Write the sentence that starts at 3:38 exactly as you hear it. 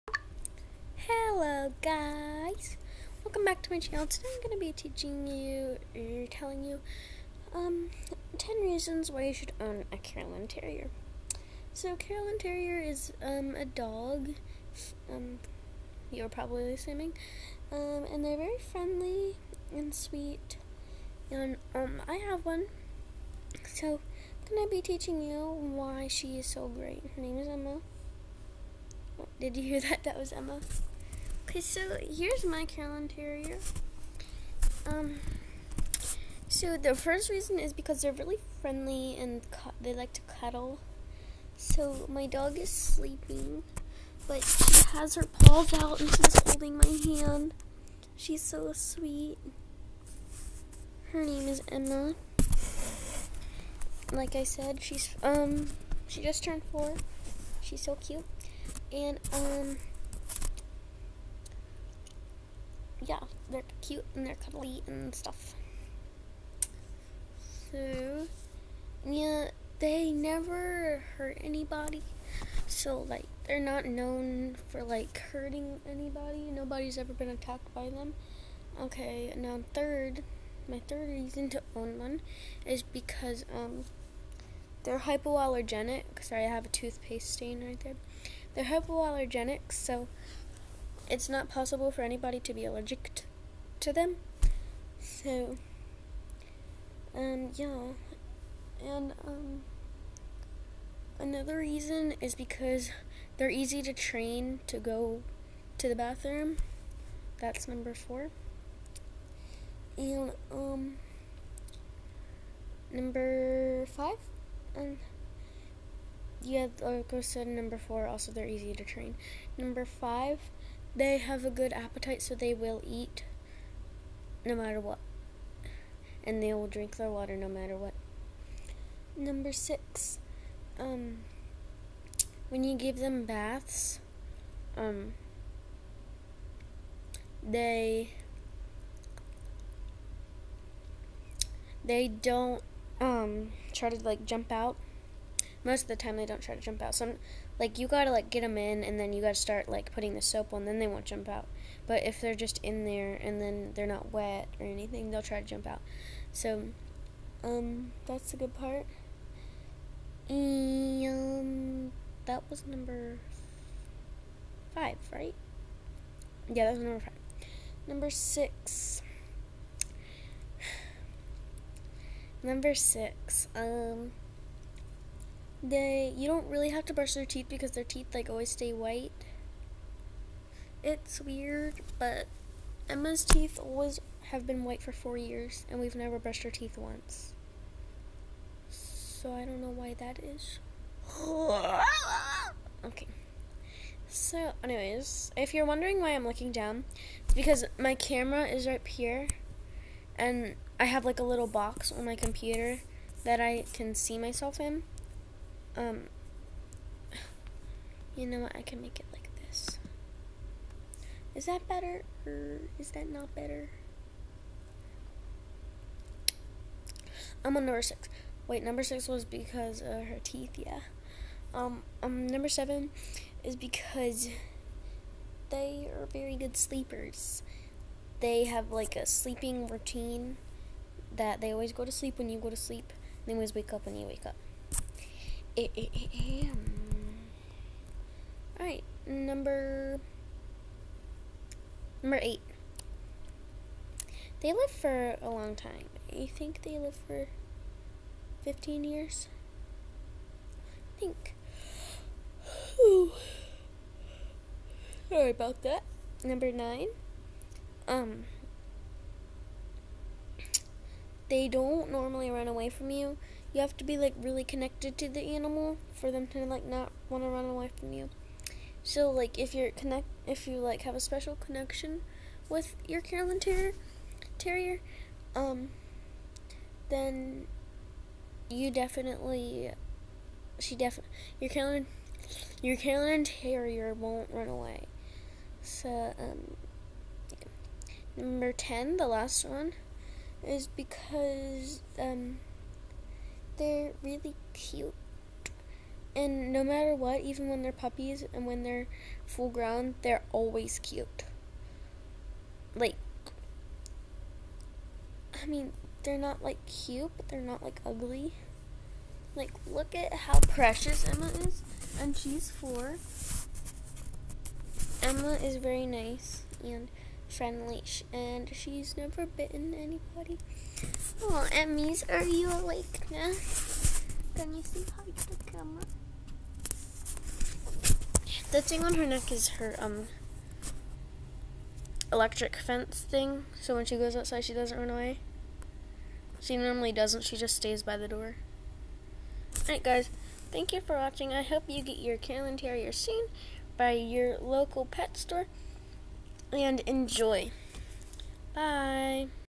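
Wait, number six was because of her teeth, yeah.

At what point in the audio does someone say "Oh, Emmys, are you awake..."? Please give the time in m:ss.
5:21.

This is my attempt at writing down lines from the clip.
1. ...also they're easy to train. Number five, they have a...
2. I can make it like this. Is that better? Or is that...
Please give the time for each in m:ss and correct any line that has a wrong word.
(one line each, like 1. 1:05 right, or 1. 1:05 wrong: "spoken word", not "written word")
1. 1:58 right
2. 3:28 right.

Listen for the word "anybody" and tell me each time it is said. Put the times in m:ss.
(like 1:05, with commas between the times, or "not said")
1:11, 1:15, 1:32, 5:19.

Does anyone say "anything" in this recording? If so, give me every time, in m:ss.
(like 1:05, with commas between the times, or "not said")
2:34.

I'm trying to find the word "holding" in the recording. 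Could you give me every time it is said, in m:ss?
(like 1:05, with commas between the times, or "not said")
0:46.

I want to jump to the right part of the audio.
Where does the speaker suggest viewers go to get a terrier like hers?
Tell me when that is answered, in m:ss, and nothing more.
5:44.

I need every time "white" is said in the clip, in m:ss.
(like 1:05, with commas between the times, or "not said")
2:58, 3:04.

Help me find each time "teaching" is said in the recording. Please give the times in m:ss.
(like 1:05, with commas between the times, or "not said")
0:04, 0:24.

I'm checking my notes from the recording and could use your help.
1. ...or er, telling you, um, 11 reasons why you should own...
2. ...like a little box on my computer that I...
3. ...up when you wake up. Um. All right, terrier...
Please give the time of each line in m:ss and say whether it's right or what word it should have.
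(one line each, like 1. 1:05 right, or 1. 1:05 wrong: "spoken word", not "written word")
1. 0:05 wrong: "10", not "11"
2. 3:21 right
3. 3:53 wrong: "number", not "terrier".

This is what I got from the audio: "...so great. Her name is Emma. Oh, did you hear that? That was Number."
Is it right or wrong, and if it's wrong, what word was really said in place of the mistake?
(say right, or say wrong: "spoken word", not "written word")
wrong: "Emma", not "Number".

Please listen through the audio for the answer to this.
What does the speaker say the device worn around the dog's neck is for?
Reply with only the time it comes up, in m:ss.
5:32.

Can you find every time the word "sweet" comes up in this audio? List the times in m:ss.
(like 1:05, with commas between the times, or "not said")
0:19, 0:48.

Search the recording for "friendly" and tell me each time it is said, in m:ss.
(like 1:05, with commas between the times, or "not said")
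0:18, 0:38, 5:17.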